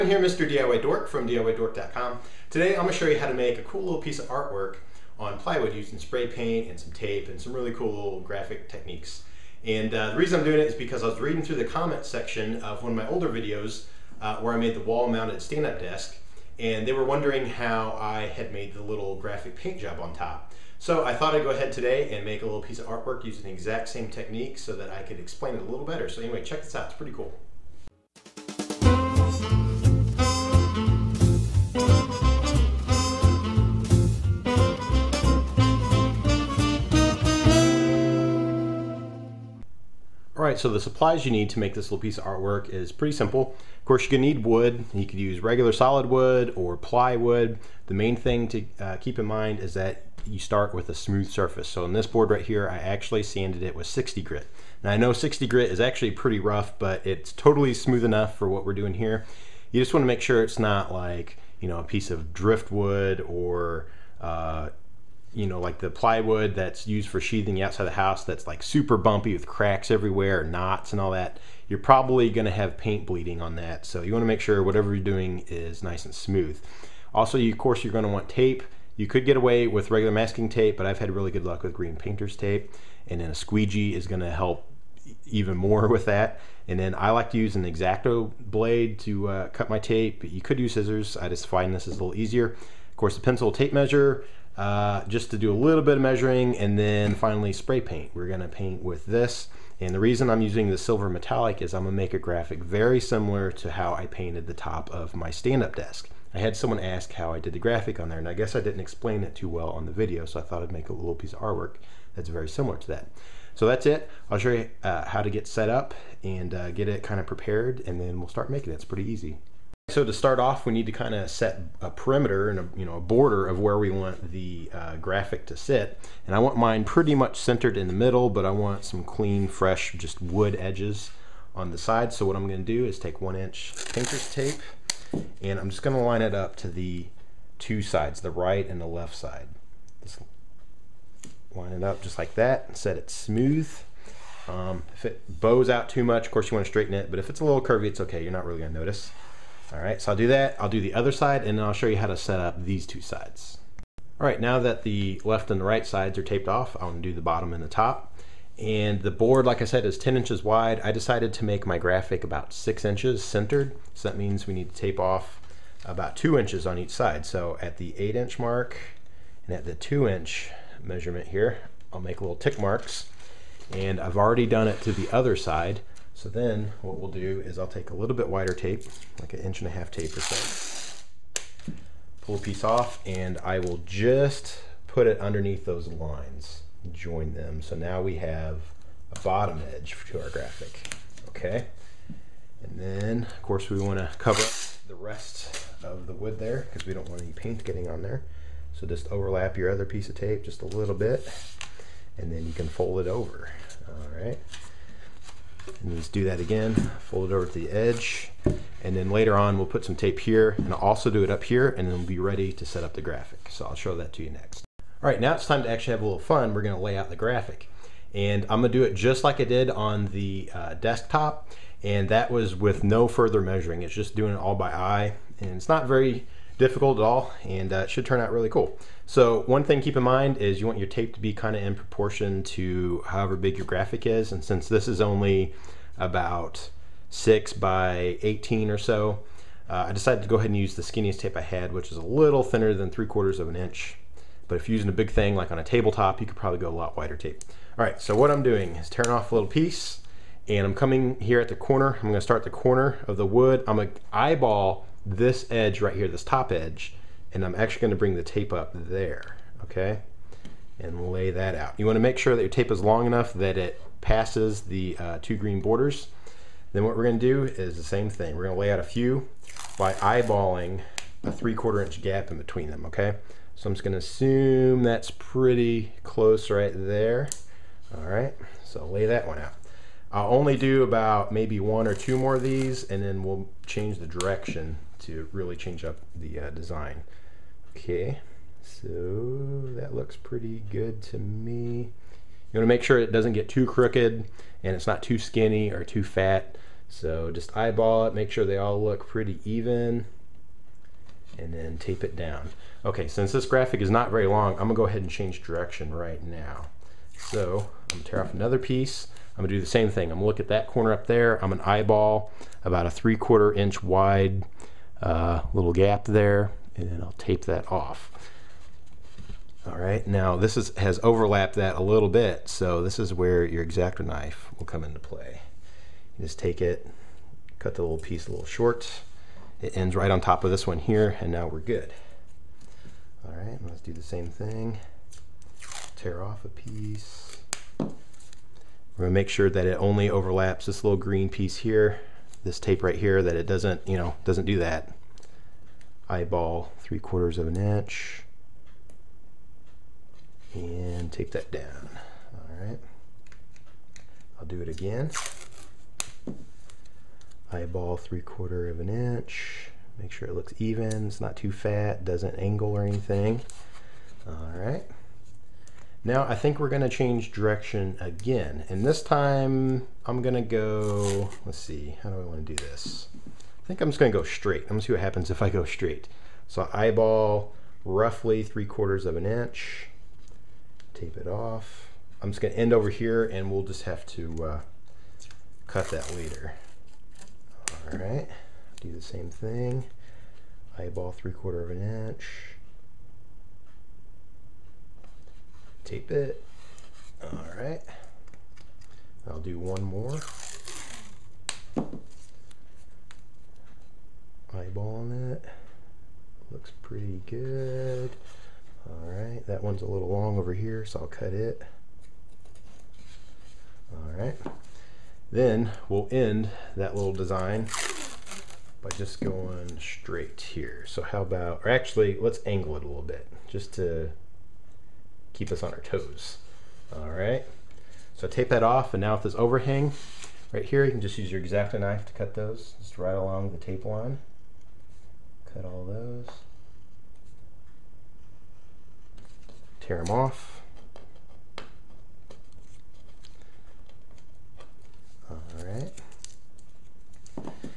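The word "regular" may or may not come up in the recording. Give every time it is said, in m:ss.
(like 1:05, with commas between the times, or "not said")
0:45, 1:19.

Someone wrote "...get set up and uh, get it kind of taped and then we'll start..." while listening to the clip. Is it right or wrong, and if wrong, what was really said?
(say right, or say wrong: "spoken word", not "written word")
wrong: "prepared", not "taped".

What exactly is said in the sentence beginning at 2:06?
And I want mine pretty much centered in the middle, but I want some clean, fresh, just wood edges on the side.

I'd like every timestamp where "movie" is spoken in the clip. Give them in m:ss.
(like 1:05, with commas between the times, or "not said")
not said.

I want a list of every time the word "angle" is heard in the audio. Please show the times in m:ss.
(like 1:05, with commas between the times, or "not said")
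6:02, 7:02.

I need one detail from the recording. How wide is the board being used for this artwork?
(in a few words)
10 inches.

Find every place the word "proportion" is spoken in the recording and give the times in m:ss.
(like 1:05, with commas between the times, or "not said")
3:51.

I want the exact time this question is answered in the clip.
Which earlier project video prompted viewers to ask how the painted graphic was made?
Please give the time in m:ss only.
0:14.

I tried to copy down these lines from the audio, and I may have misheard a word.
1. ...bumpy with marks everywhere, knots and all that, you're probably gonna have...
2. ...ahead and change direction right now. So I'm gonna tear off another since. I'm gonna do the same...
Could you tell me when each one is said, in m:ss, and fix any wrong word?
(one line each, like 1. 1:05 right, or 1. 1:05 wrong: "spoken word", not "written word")
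1. 1:08 wrong: "cracks", not "marks"
2. 5:04 wrong: "piece", not "since".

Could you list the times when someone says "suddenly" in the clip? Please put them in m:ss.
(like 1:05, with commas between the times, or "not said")
not said.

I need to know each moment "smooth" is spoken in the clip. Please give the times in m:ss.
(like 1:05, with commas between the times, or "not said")
0:50, 0:57, 1:16, 2:23.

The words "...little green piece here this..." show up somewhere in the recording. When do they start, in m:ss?
5:40.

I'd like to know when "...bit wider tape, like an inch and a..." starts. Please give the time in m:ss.
2:58.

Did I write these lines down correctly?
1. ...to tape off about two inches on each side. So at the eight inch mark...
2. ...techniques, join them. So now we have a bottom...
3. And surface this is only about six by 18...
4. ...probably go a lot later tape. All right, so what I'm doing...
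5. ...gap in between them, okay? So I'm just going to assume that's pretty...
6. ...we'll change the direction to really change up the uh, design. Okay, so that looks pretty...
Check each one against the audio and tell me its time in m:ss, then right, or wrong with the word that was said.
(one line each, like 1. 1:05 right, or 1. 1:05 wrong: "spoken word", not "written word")
1. 2:44 right
2. 3:05 wrong: "lines", not "techniques"
3. 3:54 wrong: "since", not "surface"
4. 4:06 wrong: "wider", not "later"
5. 4:32 right
6. 4:43 right.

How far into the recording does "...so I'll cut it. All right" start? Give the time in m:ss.
6:50.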